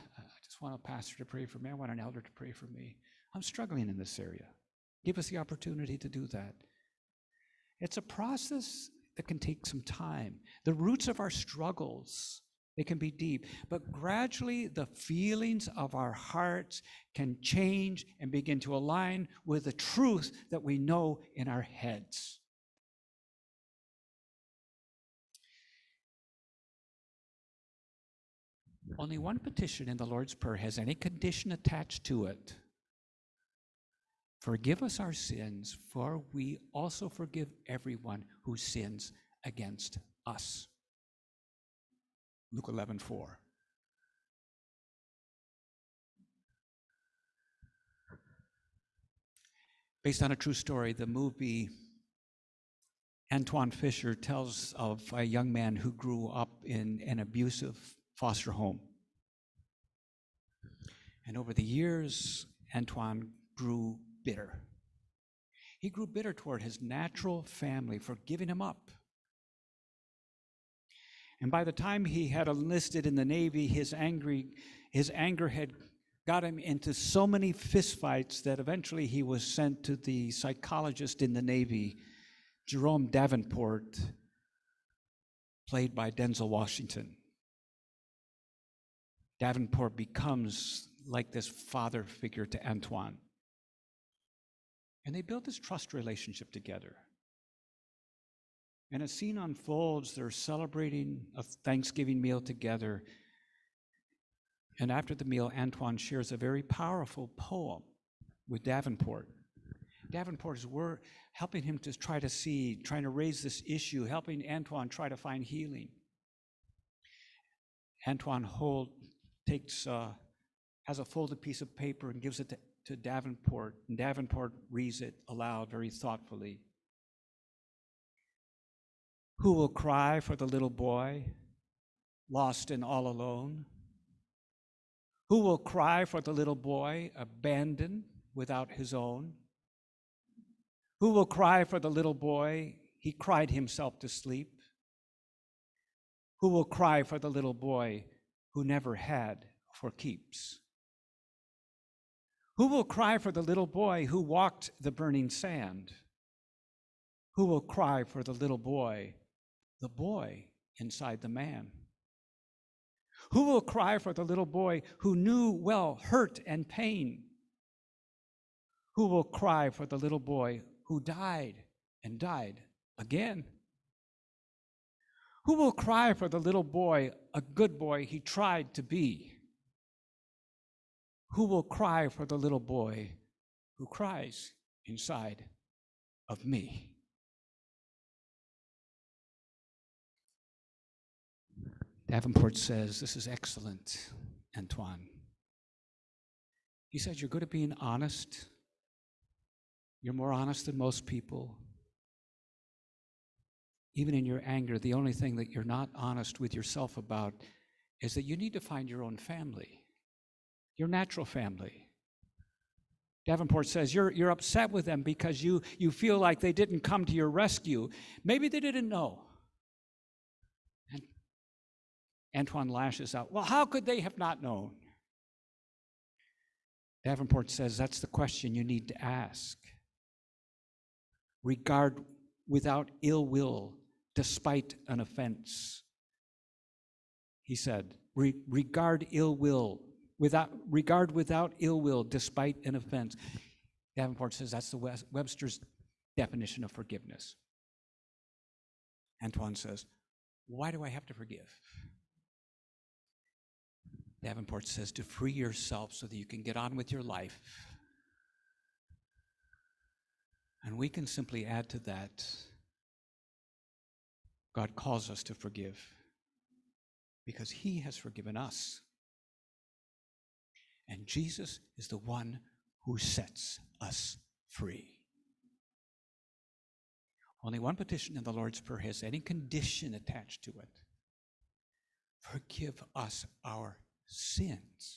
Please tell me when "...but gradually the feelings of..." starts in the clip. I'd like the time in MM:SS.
00:13.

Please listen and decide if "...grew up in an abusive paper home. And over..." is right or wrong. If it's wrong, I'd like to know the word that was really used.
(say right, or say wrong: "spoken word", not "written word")
wrong: "foster", not "paper".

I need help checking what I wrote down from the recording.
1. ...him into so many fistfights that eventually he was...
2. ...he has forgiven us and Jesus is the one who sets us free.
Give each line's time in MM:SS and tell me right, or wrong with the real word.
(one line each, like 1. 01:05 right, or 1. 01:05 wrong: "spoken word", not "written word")
1. 01:16 right
2. 04:27 right.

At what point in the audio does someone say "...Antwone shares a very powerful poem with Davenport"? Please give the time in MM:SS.
01:45.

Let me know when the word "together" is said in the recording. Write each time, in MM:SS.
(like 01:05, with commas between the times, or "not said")
01:36, 01:42.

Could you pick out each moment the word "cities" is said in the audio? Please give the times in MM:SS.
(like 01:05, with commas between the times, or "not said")
not said.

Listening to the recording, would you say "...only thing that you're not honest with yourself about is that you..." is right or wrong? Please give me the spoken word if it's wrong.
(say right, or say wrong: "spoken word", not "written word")
right.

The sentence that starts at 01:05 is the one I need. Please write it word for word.
He grew bitter toward his natural family for giving him up.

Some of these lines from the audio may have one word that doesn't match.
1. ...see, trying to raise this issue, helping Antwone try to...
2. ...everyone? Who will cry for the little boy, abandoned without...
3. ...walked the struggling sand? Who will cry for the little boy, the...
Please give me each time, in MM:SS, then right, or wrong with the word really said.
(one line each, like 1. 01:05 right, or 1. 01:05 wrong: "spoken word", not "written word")
1. 01:52 right
2. 02:13 wrong: "alone", not "everyone"
3. 02:34 wrong: "burning", not "struggling".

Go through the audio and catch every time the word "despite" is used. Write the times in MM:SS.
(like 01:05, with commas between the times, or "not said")
03:54, 04:02.